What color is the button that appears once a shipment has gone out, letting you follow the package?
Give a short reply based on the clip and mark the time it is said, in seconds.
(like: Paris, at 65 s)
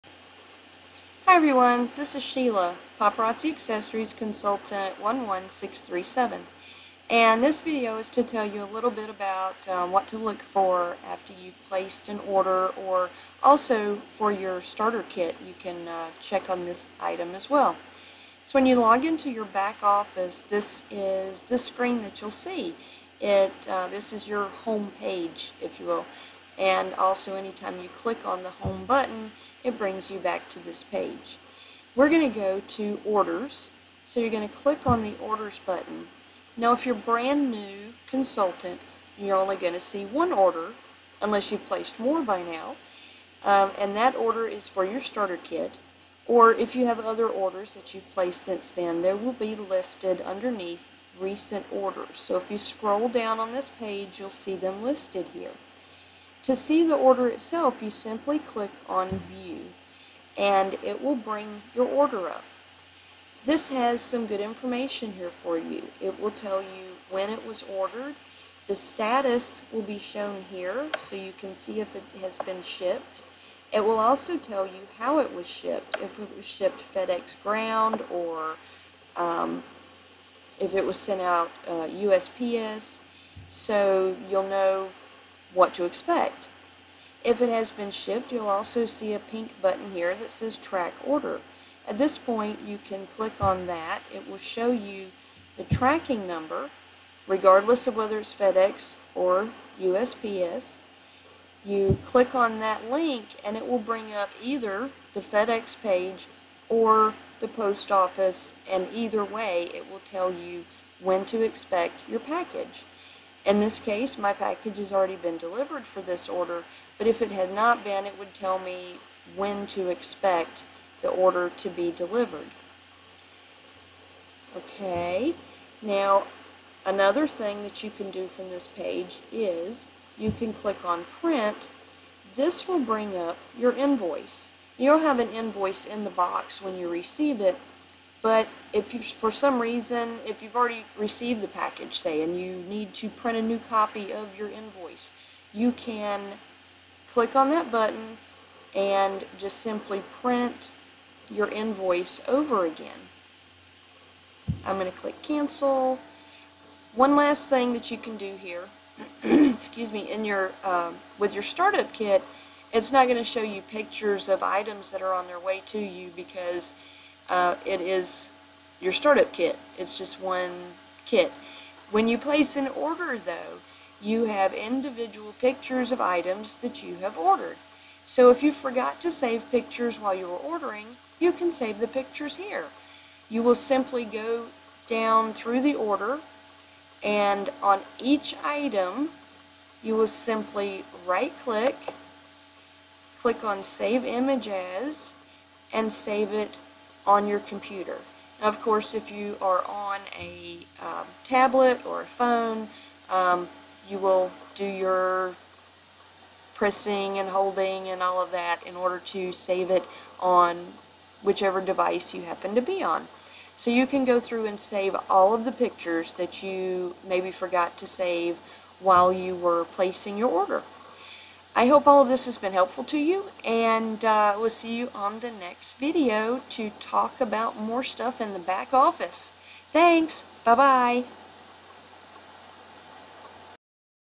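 Pink, at 89 s.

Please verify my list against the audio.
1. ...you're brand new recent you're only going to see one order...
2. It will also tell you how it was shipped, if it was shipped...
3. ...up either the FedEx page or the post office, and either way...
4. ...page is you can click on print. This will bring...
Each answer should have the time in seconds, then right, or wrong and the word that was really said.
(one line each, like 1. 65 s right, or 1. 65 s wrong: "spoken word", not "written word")
1. 36 s wrong: "consultant", not "recent"
2. 73 s right
3. 104 s right
4. 128 s right.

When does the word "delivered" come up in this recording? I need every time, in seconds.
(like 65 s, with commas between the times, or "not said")
115 s, 121 s.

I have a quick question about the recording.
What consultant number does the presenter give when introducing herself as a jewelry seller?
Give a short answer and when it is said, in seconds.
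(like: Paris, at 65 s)
11637, at 4 s.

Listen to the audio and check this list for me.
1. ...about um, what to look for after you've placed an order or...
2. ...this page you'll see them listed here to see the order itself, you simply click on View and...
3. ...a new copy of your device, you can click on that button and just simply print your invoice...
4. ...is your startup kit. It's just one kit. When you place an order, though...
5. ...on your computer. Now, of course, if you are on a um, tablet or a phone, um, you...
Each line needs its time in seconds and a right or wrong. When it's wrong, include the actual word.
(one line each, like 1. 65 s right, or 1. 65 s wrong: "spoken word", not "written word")
1. 9 s right
2. 53 s right
3. 143 s wrong: "invoice", not "device"
4. 167 s right
5. 197 s right.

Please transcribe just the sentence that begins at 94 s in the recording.
It will show you the tracking number, regardless of whether it's FedEx or USPS.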